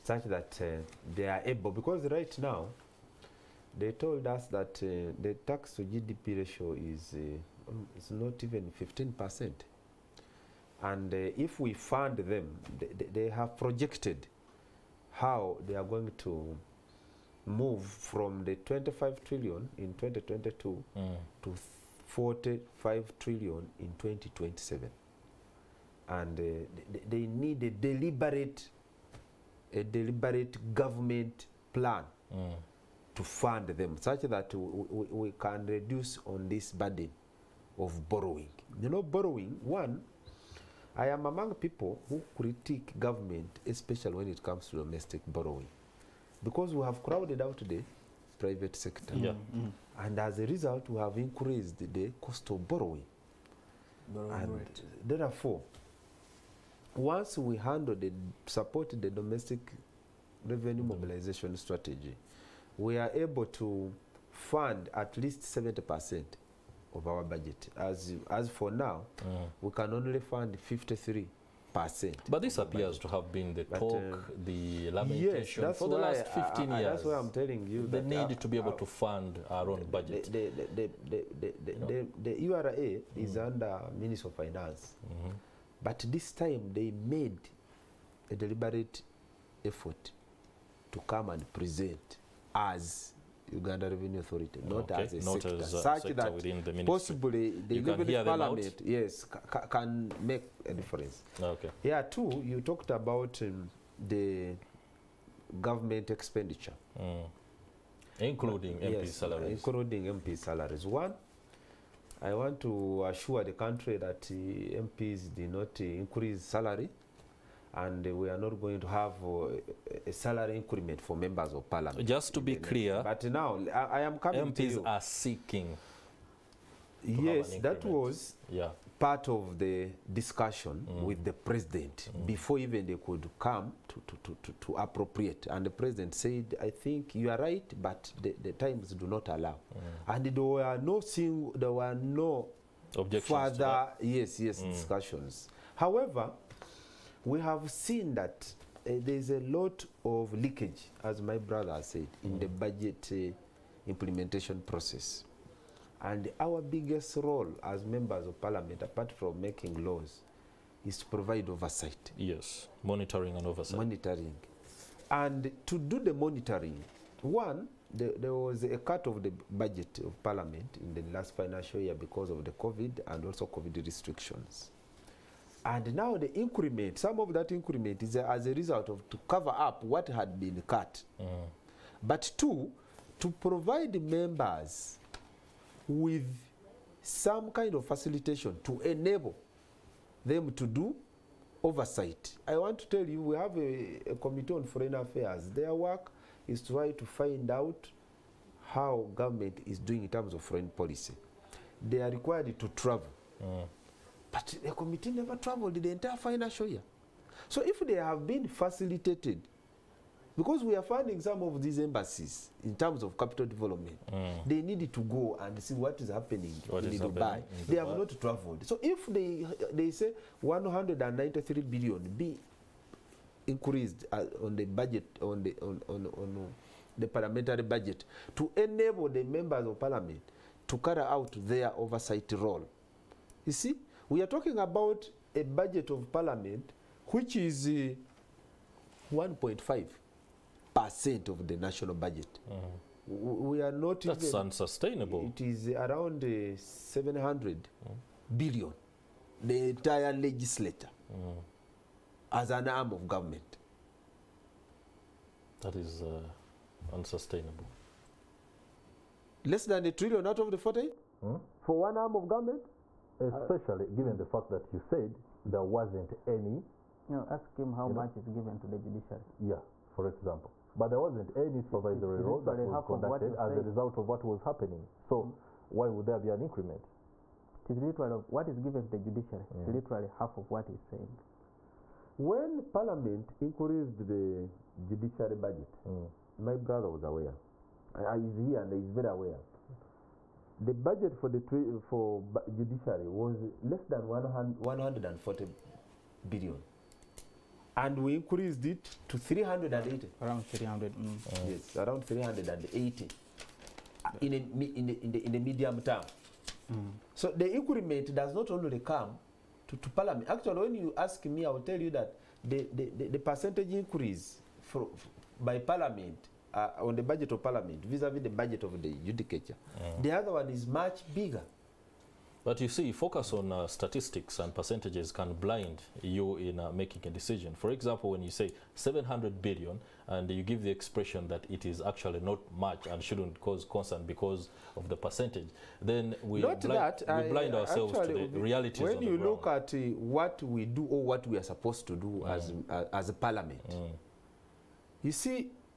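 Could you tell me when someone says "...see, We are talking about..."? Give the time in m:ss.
3:53.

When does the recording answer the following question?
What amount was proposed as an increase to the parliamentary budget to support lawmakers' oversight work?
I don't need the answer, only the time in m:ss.
3:40.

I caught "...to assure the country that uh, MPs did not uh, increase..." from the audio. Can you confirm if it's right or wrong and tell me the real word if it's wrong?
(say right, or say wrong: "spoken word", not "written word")
right.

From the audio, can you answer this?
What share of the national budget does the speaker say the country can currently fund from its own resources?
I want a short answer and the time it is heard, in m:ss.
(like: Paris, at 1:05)
53%, at 1:10.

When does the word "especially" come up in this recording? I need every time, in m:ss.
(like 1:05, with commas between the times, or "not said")
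0:43, 4:23.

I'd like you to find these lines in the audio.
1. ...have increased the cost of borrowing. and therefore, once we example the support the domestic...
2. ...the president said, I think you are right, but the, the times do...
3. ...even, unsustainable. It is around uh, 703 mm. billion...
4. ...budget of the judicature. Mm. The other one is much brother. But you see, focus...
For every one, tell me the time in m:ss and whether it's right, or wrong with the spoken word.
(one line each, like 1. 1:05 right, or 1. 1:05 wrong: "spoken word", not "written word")
1. 0:50 wrong: "handle", not "example"
2. 2:15 right
3. 4:04 wrong: "700", not "703"
4. 5:18 wrong: "bigger", not "brother".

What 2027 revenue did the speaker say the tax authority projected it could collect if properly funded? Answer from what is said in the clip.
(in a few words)
45 trillion.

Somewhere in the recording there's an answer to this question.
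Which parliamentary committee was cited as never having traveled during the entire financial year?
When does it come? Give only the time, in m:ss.
3:14.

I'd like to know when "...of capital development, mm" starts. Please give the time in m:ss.
3:33.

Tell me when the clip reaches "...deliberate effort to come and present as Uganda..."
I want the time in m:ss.
1:28.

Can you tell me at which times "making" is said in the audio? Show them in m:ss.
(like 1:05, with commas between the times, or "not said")
2:39, 5:26.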